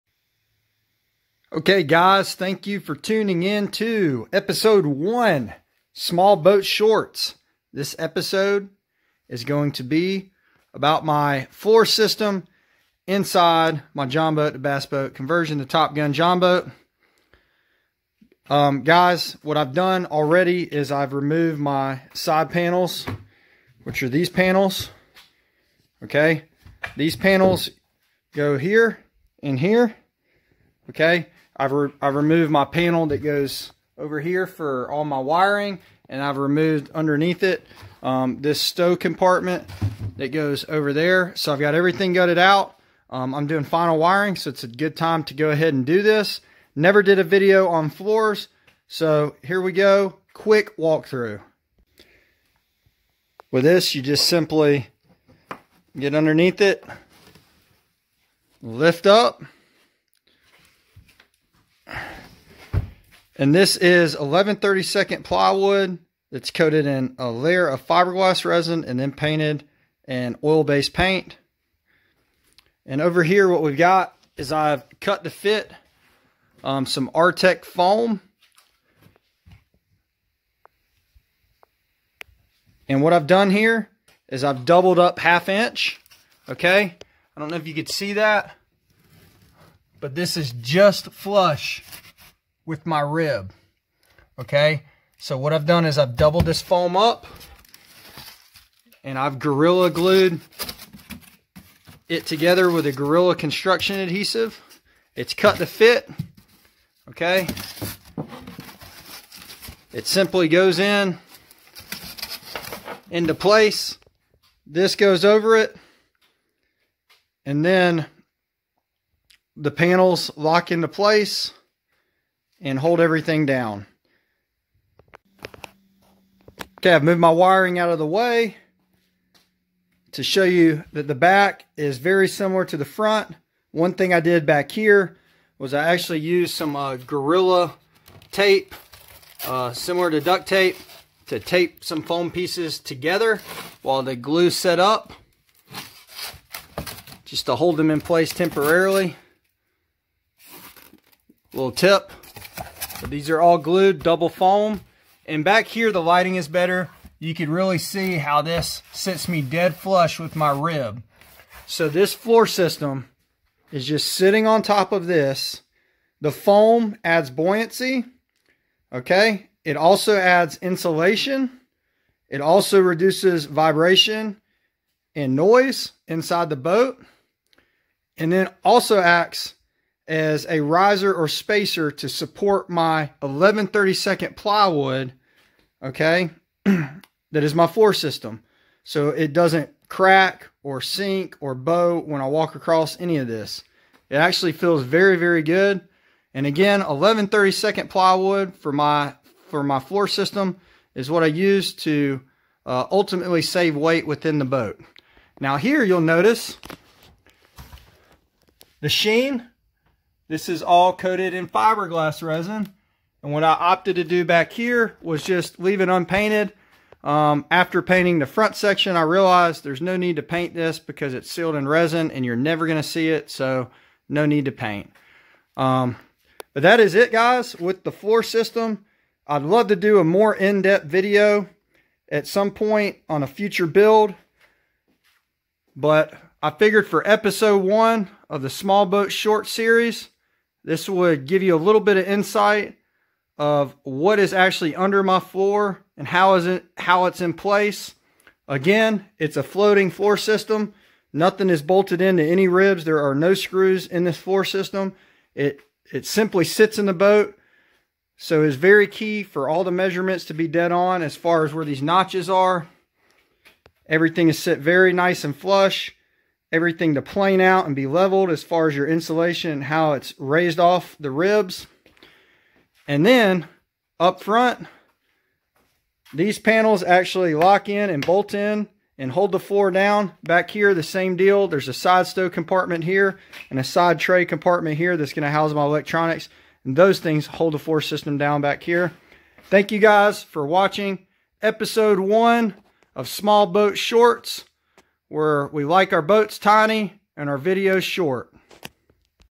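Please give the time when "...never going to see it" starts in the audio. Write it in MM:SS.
03:42.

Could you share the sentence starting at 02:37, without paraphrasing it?
You can really see how this sits me dead flush with my rib.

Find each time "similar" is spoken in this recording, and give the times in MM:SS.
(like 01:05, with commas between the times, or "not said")
02:12, 02:19.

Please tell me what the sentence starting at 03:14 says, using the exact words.
It actually feels very, very good.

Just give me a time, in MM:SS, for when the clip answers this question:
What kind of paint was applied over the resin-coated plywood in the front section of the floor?
01:10.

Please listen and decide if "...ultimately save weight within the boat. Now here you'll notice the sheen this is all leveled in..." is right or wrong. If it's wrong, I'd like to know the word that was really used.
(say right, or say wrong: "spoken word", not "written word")
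wrong: "coated", not "leveled".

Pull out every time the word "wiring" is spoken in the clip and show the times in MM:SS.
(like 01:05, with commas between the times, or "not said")
00:35, 00:43, 02:07.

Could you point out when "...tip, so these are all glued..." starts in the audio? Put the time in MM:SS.
02:31.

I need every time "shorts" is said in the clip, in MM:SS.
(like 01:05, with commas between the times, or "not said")
00:06, 03:59, 04:53, 04:57.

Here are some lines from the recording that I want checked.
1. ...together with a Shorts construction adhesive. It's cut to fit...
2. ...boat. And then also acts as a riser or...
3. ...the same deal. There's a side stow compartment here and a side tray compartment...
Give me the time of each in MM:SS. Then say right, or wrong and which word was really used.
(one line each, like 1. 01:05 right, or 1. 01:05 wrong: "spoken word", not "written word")
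1. 01:42 wrong: "Gorilla", not "Shorts"
2. 02:56 right
3. 04:40 right.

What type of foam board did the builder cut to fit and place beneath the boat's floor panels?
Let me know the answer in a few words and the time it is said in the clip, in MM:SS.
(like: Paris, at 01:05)
R-Tech, at 01:17.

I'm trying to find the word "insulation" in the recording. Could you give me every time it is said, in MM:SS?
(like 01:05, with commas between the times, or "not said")
02:50, 04:28.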